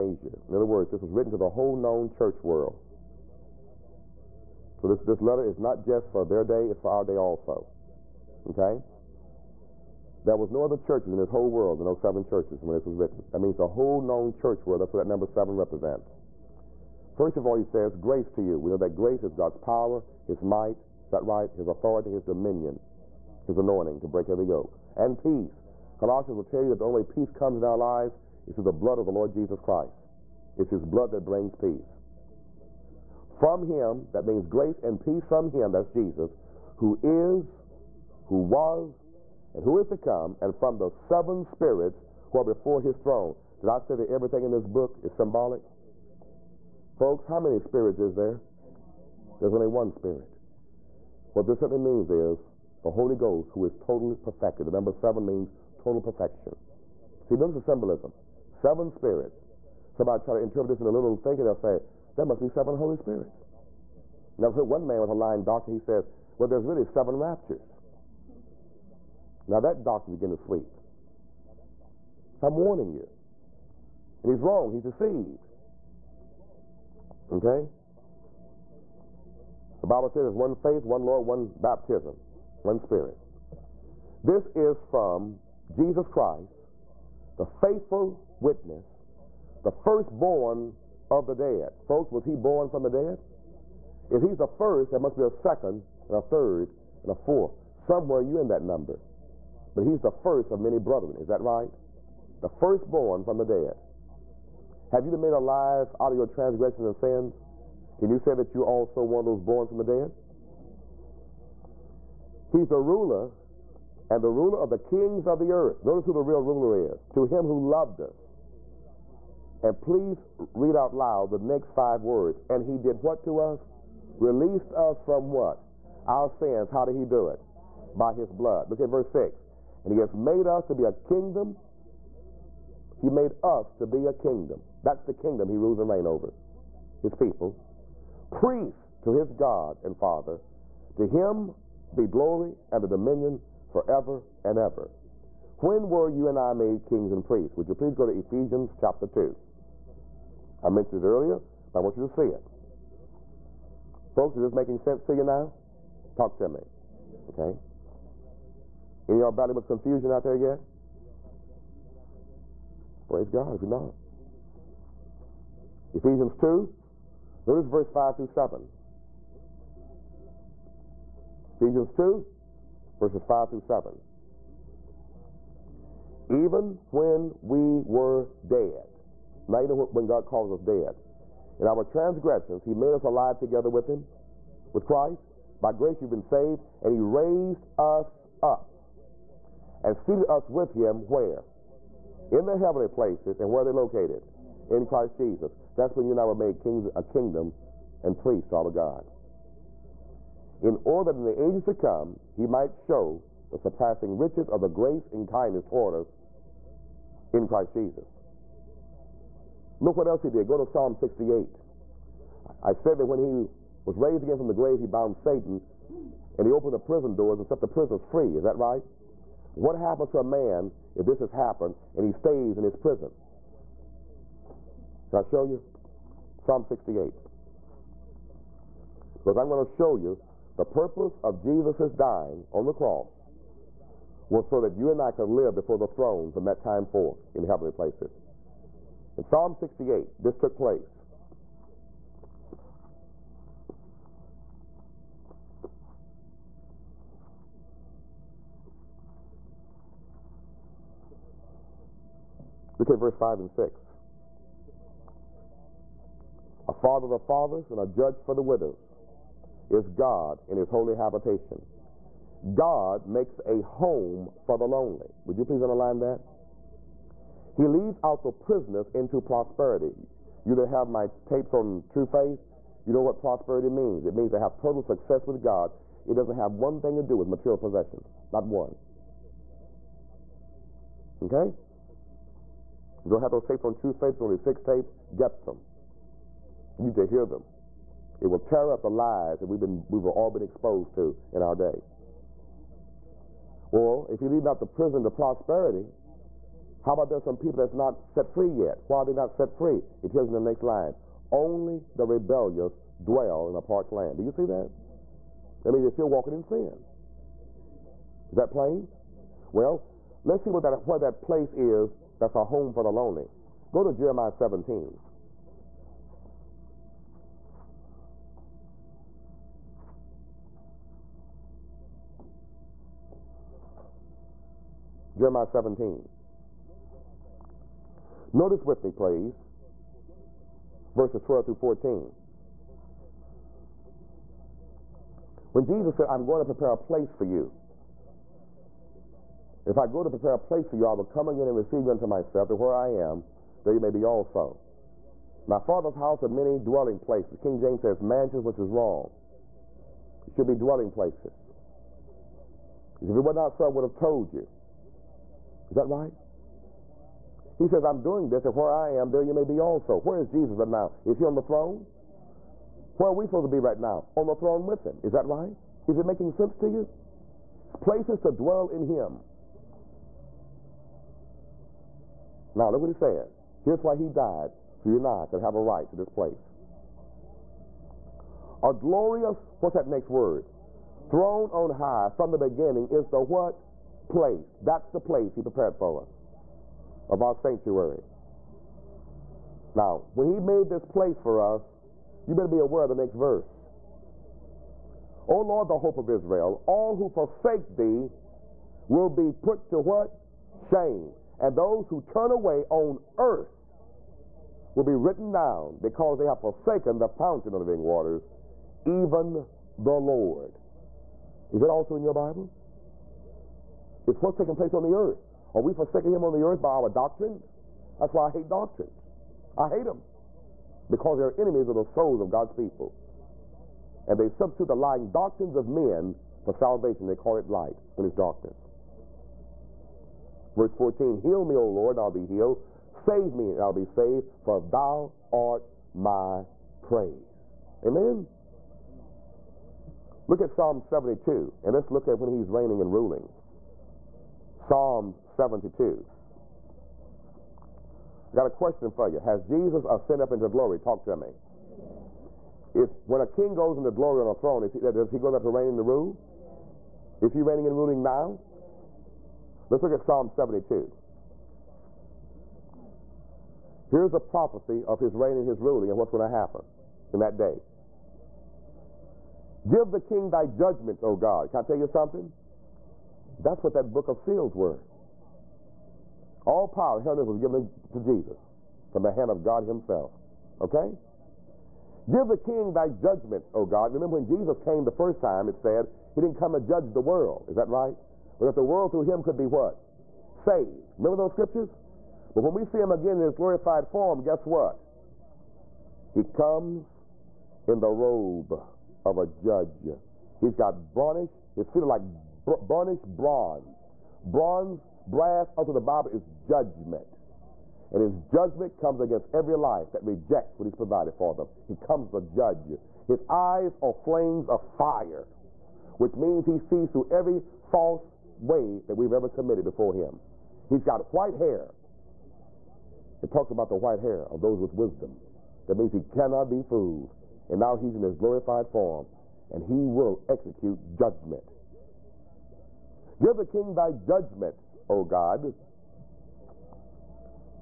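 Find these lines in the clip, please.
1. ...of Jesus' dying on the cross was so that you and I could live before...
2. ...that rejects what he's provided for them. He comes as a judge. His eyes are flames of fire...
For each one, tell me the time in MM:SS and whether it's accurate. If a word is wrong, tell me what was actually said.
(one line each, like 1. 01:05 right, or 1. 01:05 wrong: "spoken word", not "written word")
1. 03:51 right
2. 08:29 right.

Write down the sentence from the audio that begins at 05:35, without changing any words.
When Jesus said, I'm going to prepare a place for you.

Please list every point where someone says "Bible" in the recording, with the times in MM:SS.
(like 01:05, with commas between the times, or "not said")
01:19, 06:52, 08:25.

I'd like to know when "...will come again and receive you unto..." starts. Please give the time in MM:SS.
05:40.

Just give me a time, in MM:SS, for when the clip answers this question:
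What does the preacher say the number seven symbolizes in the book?
00:55.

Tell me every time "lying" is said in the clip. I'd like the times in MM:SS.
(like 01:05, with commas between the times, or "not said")
01:05, 07:04.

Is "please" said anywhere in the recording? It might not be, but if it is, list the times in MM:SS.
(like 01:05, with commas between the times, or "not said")
01:59, 02:27, 04:25, 05:28.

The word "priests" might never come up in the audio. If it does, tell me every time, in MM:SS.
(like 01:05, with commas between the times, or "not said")
02:18, 02:27, 03:18.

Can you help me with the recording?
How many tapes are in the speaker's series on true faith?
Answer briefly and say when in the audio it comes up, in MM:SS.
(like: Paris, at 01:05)
6, at 04:44.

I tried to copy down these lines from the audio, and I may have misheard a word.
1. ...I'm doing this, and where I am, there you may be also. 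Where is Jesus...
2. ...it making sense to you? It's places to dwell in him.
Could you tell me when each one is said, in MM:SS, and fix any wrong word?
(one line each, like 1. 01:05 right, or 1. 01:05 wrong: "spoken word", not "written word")
1. 05:57 right
2. 06:05 right.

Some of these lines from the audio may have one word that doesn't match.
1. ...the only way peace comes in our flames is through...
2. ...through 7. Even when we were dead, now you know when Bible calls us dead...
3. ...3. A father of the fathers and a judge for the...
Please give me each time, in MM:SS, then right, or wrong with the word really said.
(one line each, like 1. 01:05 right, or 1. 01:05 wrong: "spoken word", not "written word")
1. 00:26 wrong: "lives", not "flames"
2. 02:53 wrong: "God", not "Bible"
3. 04:13 wrong: "6", not "3".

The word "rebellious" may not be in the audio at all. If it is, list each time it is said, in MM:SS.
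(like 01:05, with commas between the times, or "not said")
05:02.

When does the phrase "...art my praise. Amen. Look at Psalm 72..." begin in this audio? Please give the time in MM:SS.
07:15.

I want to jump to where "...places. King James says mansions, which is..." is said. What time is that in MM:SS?
05:46.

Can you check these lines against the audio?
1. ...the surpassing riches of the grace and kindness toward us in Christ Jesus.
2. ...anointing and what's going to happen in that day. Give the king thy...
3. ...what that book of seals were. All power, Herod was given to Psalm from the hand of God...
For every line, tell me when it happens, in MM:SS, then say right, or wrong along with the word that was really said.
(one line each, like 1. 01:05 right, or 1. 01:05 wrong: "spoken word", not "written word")
1. 03:23 right
2. 07:45 wrong: "ruling", not "anointing"
3. 07:53 wrong: "Jesus", not "Psalm".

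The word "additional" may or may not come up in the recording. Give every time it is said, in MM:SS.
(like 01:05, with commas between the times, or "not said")
not said.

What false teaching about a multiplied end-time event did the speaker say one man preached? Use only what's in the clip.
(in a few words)
Seven raptures.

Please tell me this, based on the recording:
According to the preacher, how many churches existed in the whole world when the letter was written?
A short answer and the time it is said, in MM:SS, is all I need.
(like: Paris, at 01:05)
7, at 00:11.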